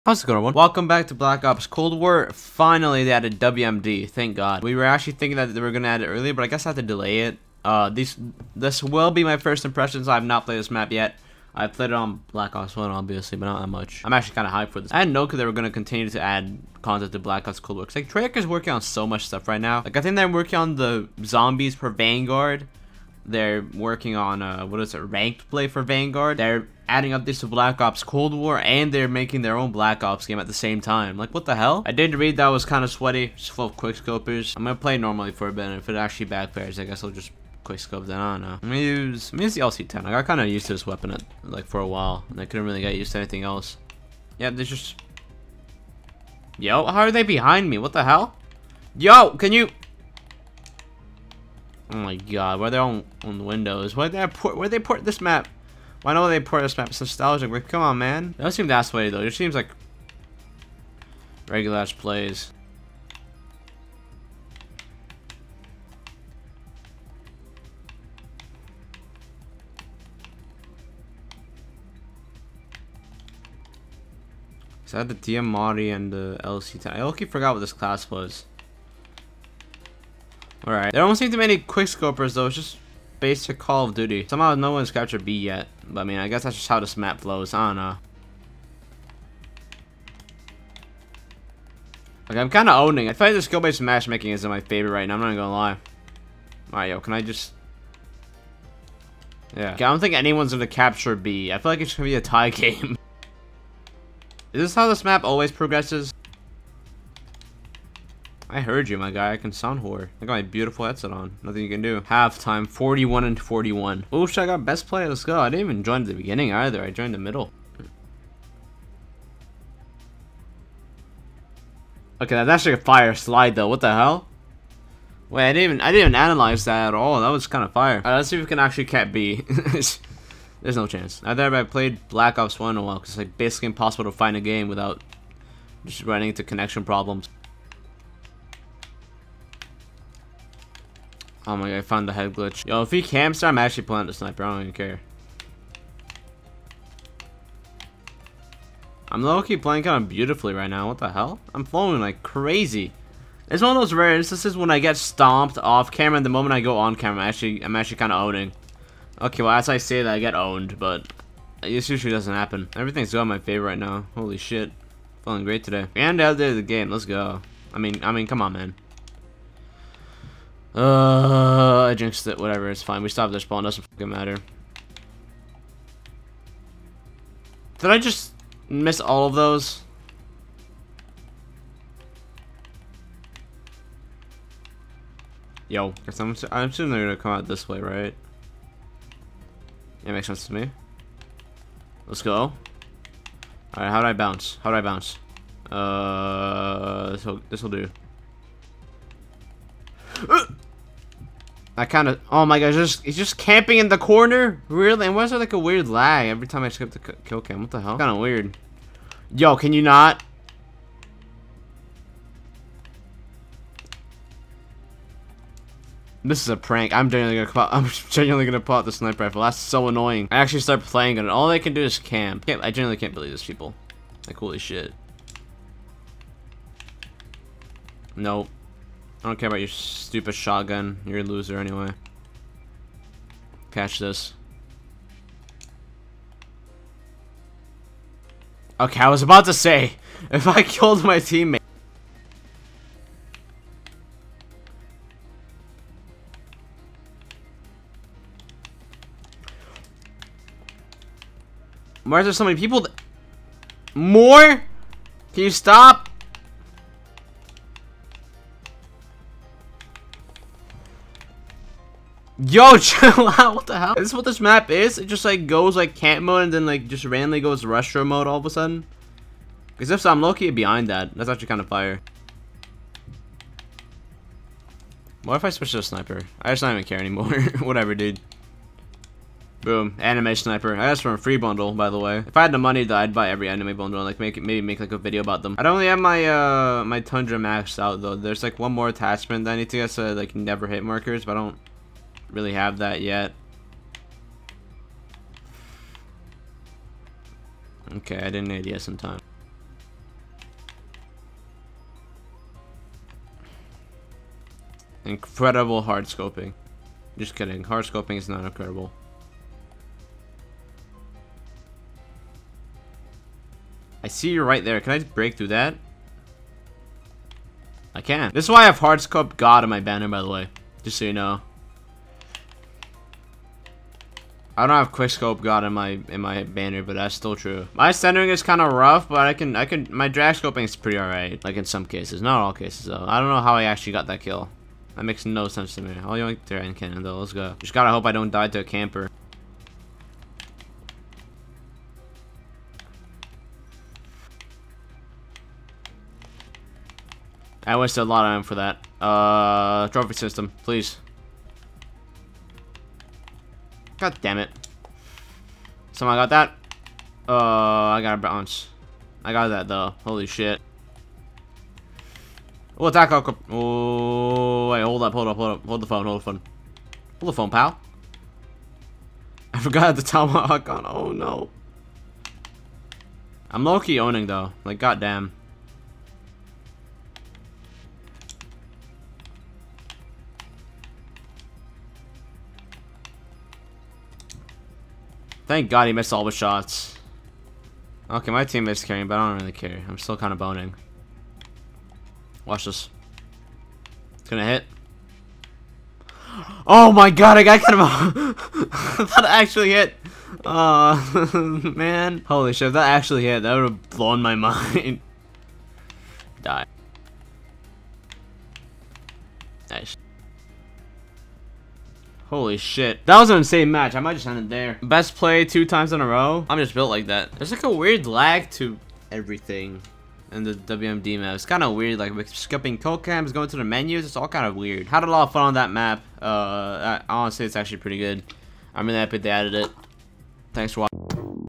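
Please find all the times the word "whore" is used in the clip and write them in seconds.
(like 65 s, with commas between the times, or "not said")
109 s.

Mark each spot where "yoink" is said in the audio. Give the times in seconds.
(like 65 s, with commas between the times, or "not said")
336 s.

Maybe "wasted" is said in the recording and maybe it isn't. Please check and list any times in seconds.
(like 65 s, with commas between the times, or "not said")
347 s.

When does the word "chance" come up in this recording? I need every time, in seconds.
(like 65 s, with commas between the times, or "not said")
130 s.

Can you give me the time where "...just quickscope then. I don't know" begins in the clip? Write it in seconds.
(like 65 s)
37 s.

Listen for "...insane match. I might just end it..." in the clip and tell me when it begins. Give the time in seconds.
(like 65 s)
413 s.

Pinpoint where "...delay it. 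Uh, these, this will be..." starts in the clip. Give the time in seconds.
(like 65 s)
6 s.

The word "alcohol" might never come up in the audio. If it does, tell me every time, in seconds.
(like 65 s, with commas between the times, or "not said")
not said.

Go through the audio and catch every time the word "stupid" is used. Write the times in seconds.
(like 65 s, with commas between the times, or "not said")
229 s.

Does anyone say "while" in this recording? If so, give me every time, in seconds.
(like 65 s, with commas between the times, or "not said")
41 s, 132 s.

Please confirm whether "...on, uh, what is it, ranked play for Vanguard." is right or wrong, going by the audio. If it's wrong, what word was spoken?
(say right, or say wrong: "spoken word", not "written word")
right.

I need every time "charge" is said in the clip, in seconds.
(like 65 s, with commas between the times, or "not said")
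not said.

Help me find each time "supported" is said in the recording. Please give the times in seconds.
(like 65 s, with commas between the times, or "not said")
not said.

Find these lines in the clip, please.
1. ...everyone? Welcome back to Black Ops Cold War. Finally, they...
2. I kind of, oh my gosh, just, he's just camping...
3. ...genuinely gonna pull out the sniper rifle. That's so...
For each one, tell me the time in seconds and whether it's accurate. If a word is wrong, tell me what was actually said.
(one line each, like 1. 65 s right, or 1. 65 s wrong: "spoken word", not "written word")
1. 0 s right
2. 201 s right
3. 218 s right.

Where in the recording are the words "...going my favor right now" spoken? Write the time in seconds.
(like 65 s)
163 s.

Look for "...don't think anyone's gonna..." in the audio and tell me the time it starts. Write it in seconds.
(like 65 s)
99 s.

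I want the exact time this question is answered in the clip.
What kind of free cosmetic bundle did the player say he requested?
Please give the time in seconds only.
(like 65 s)
281 s.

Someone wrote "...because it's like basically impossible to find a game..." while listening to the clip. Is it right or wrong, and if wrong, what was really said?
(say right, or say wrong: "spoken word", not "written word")
right.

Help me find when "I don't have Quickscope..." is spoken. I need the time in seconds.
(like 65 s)
324 s.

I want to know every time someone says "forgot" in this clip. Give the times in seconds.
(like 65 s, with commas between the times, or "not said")
77 s, 369 s.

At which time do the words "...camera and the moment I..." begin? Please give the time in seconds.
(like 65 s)
155 s.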